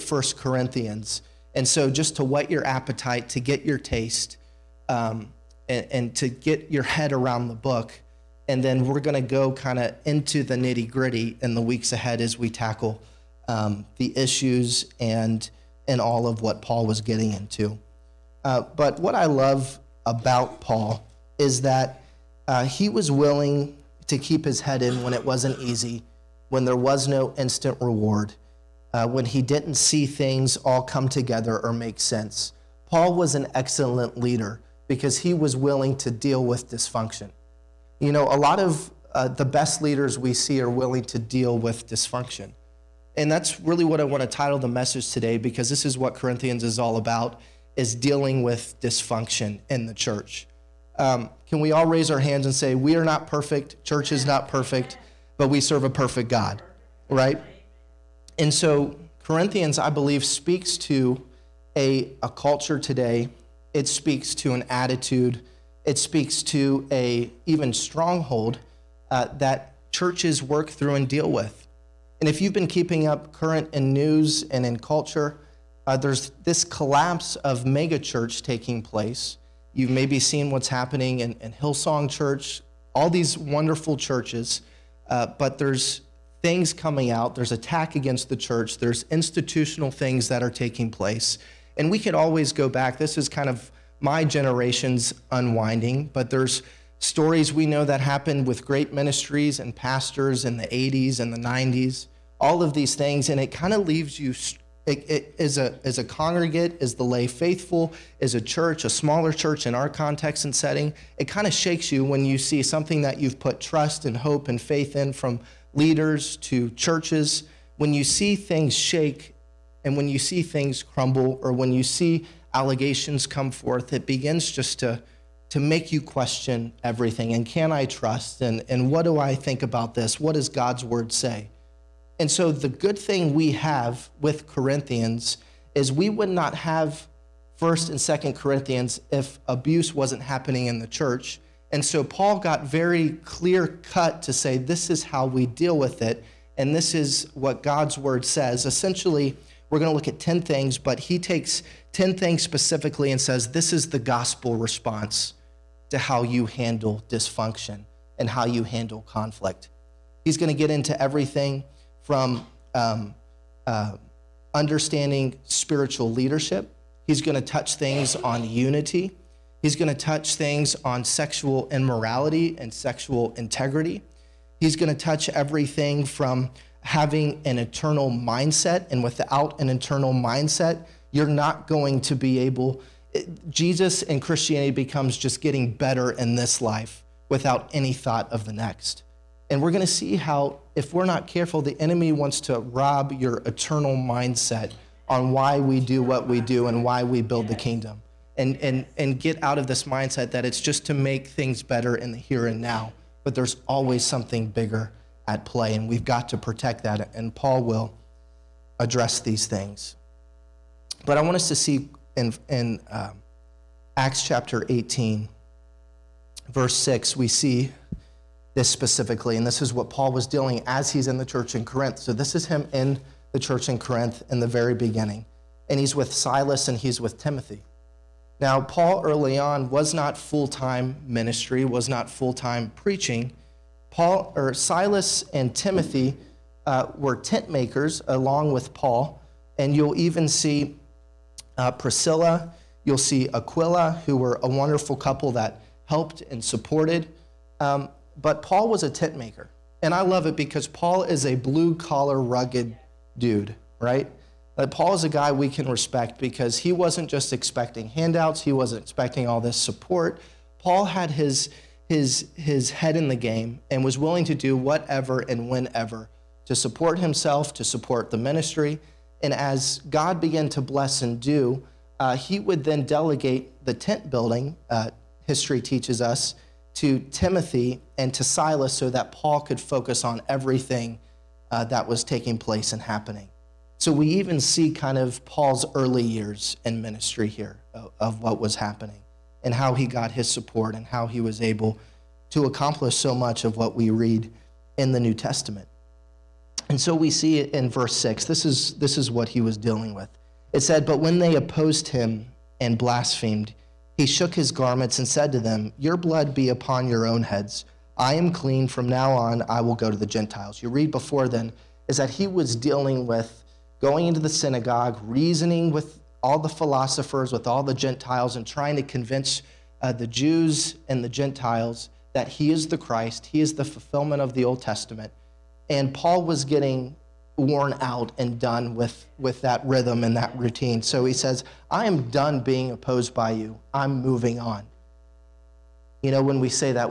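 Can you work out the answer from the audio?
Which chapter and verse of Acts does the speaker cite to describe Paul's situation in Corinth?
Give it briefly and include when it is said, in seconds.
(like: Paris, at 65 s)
Acts 18:6, at 213 s.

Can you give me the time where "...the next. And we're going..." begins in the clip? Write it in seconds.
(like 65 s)
188 s.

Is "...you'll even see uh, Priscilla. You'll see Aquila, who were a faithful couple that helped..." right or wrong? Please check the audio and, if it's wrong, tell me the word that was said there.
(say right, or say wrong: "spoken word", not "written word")
wrong: "wonderful", not "faithful".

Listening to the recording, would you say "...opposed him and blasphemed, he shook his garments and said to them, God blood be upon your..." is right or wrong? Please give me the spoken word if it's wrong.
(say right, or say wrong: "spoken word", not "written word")
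wrong: "Your", not "God".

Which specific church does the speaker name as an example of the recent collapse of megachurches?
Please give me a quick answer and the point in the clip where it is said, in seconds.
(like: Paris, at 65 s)
Hillsong Church, at 81 s.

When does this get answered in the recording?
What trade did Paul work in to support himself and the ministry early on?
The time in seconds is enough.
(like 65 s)
248 s.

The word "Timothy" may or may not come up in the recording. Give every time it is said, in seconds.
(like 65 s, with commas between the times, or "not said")
227 s, 235 s, 276 s.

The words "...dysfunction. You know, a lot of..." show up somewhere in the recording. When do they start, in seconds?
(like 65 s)
36 s.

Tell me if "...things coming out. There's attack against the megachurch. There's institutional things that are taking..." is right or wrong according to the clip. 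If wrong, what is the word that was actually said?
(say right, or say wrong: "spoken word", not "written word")
wrong: "church", not "megachurch".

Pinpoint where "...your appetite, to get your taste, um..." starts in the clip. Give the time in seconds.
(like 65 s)
2 s.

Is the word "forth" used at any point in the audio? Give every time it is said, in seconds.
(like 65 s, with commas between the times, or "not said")
123 s.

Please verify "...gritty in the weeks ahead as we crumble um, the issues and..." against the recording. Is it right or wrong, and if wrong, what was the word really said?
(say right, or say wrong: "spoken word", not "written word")
wrong: "tackle", not "crumble".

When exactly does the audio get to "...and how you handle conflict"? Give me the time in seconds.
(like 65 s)
158 s.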